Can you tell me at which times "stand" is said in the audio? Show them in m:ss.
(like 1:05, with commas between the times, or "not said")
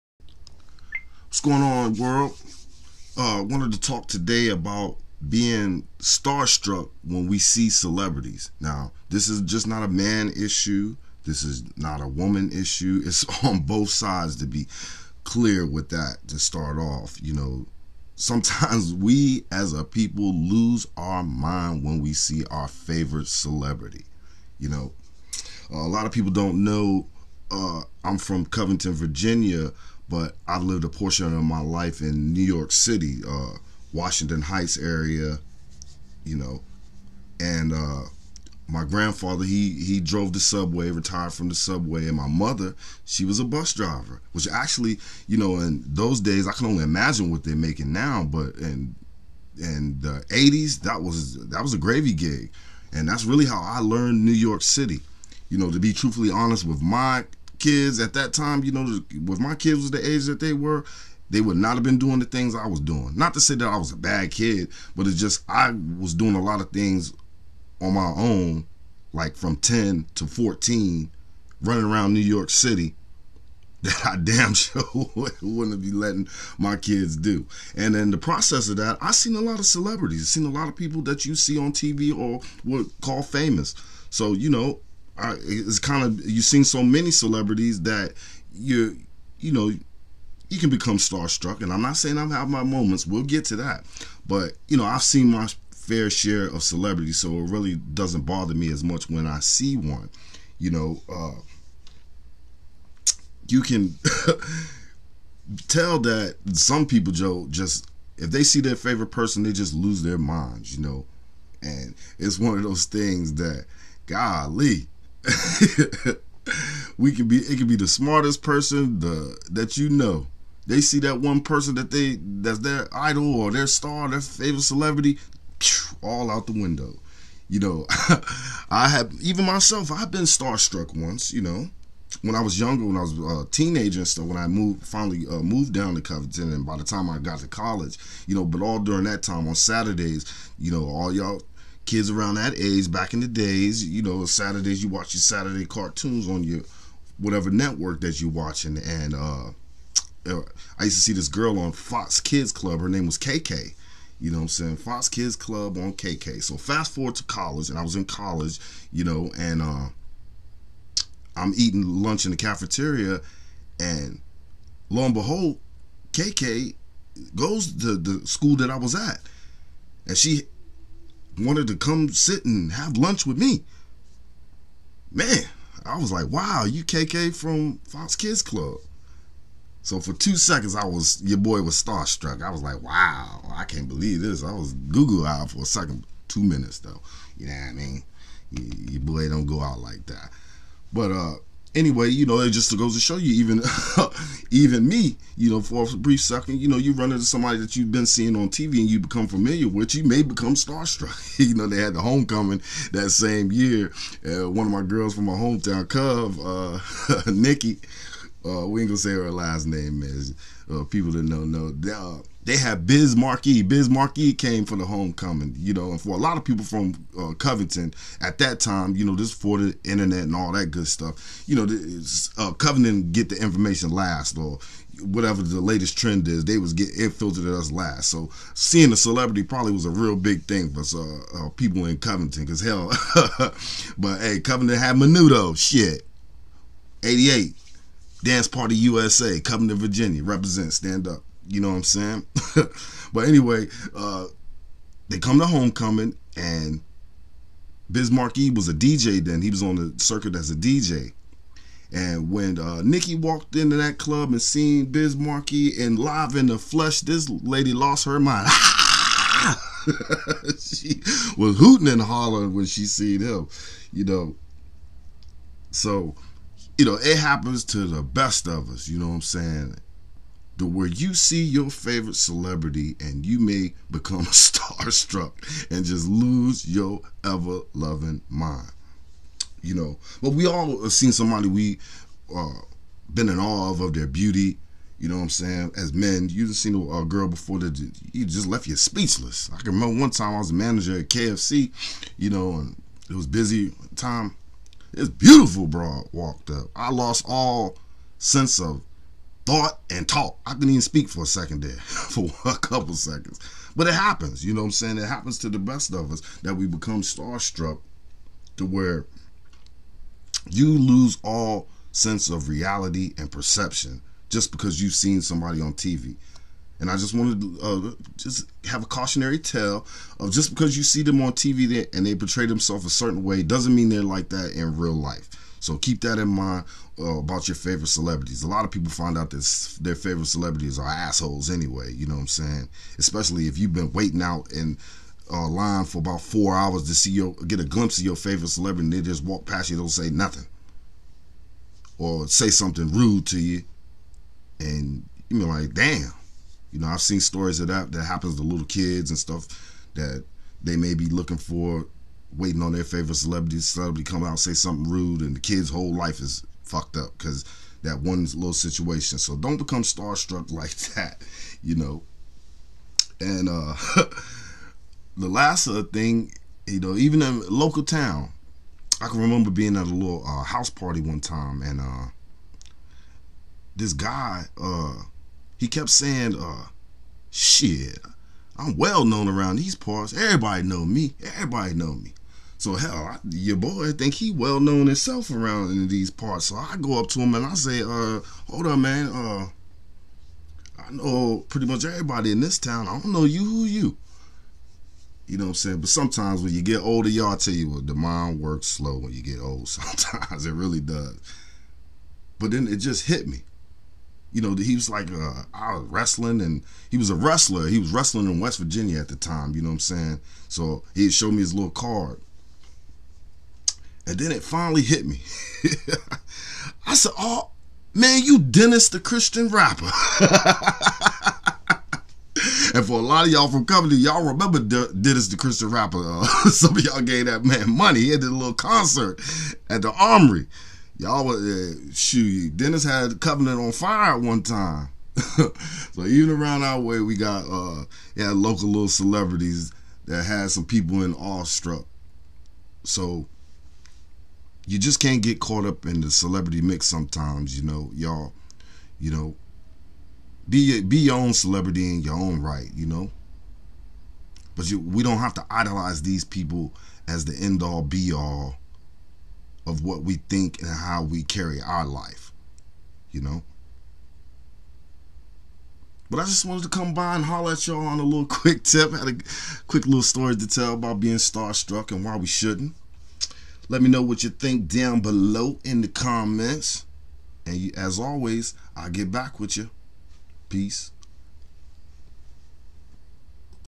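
4:00.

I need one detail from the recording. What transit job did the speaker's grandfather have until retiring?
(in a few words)
Drove the subway.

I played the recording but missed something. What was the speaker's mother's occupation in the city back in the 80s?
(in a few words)
Bus driver.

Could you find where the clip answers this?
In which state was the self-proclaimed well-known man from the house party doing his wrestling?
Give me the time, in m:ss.
6:48.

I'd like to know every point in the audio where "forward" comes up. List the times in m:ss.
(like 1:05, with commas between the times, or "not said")
2:36.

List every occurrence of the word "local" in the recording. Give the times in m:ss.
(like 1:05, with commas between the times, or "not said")
6:07, 7:18.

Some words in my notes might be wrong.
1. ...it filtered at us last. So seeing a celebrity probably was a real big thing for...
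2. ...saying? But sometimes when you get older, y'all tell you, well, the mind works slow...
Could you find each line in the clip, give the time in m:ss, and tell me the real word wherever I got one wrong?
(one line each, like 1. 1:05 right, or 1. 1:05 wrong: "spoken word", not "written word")
1. 3:47 right
2. 6:35 right.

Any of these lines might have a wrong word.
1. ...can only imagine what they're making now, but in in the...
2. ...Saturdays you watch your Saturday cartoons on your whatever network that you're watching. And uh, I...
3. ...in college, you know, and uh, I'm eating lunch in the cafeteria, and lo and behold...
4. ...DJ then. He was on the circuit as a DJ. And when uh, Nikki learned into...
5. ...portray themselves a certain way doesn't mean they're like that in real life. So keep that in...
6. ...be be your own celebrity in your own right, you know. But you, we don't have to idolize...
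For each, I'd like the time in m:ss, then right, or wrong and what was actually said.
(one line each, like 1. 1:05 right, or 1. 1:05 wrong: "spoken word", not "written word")
1. 0:46 right
2. 2:24 right
3. 2:37 right
4. 4:08 wrong: "walked", not "learned"
5. 5:22 right
6. 7:30 right.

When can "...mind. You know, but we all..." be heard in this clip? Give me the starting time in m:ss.
4:38.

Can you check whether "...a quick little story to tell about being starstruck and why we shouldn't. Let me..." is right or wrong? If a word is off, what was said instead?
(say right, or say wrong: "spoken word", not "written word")
right.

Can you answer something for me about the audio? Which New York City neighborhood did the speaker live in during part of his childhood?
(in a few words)
Washington Heights.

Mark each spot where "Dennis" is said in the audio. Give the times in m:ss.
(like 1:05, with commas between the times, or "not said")
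6:58, 7:04, 7:12.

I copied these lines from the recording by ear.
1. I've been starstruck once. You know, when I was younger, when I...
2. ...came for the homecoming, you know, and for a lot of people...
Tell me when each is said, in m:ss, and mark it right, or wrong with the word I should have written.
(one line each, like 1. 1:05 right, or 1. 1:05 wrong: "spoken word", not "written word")
1. 2:09 right
2. 3:34 right.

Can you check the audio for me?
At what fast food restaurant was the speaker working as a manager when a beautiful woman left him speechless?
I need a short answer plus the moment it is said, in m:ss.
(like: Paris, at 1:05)
KFC, at 4:51.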